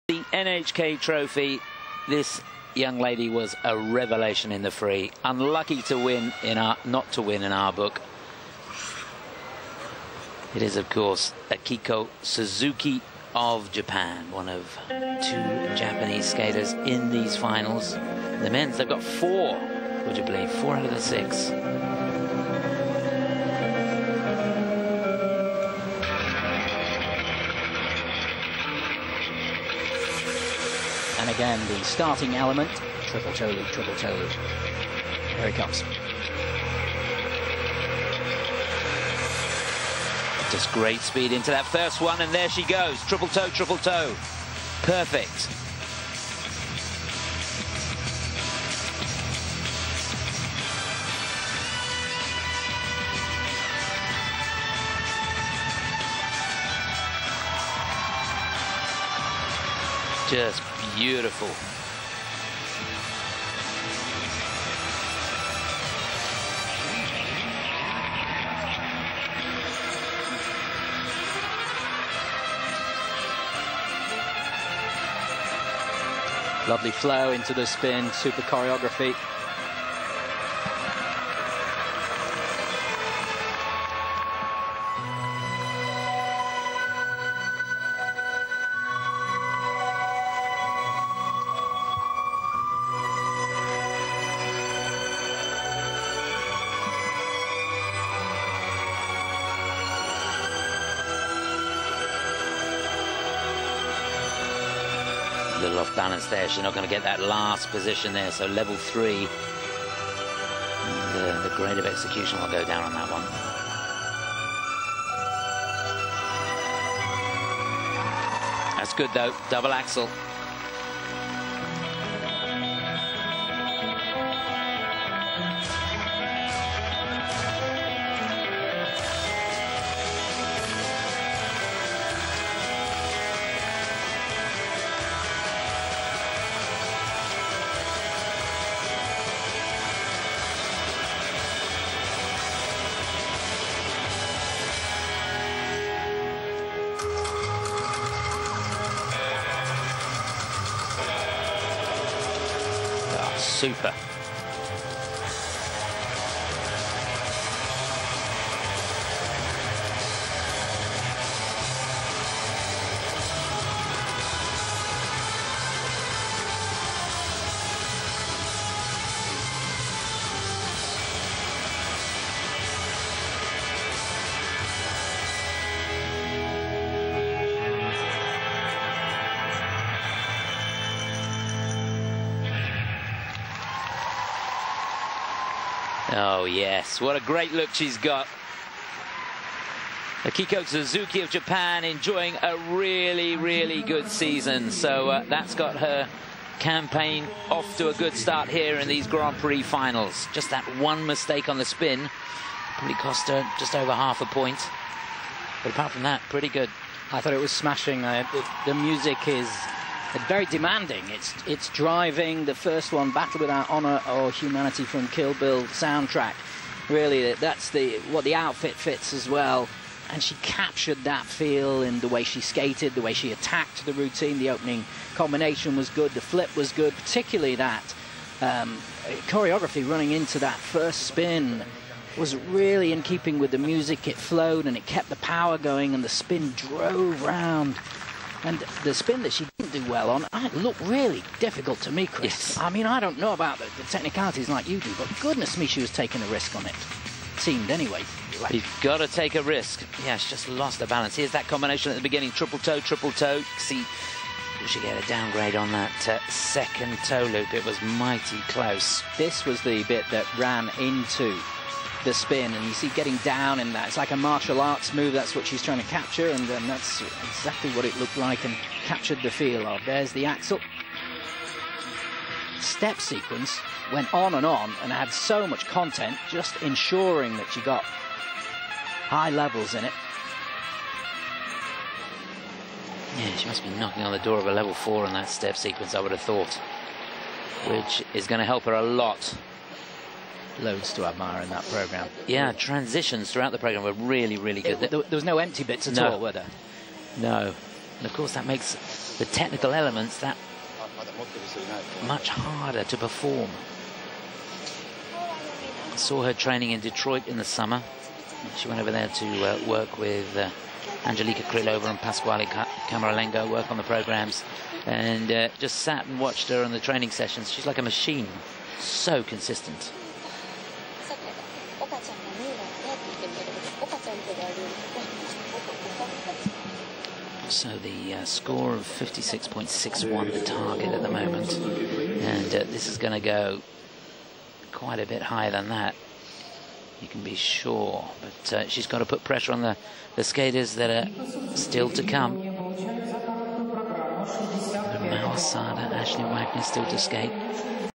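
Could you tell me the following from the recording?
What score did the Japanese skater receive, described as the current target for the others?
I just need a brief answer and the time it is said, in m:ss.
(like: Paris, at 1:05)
56.61, at 5:28.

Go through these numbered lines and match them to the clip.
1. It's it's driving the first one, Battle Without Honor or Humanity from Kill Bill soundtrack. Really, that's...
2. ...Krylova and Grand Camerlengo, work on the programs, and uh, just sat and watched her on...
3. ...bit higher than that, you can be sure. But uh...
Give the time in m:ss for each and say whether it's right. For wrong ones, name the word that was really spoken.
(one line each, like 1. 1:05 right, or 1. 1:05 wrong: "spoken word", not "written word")
1. 3:31 right
2. 5:11 wrong: "Pasquale", not "Grand"
3. 5:35 right.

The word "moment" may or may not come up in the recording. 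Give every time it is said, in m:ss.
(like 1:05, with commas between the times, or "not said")
5:31.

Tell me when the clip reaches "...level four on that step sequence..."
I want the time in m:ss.
4:44.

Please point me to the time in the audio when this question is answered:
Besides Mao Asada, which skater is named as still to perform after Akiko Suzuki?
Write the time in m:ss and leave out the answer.
5:45.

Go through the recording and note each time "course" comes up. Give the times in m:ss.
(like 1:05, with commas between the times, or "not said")
0:10, 4:58.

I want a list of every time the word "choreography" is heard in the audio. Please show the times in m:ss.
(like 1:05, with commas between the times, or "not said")
1:18, 3:49.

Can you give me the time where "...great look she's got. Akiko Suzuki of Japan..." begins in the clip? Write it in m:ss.
3:07.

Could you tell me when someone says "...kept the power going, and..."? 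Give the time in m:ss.
3:54.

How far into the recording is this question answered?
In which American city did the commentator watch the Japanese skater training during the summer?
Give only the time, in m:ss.
5:06.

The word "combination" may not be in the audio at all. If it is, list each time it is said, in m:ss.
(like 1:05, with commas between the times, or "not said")
3:45, 4:11.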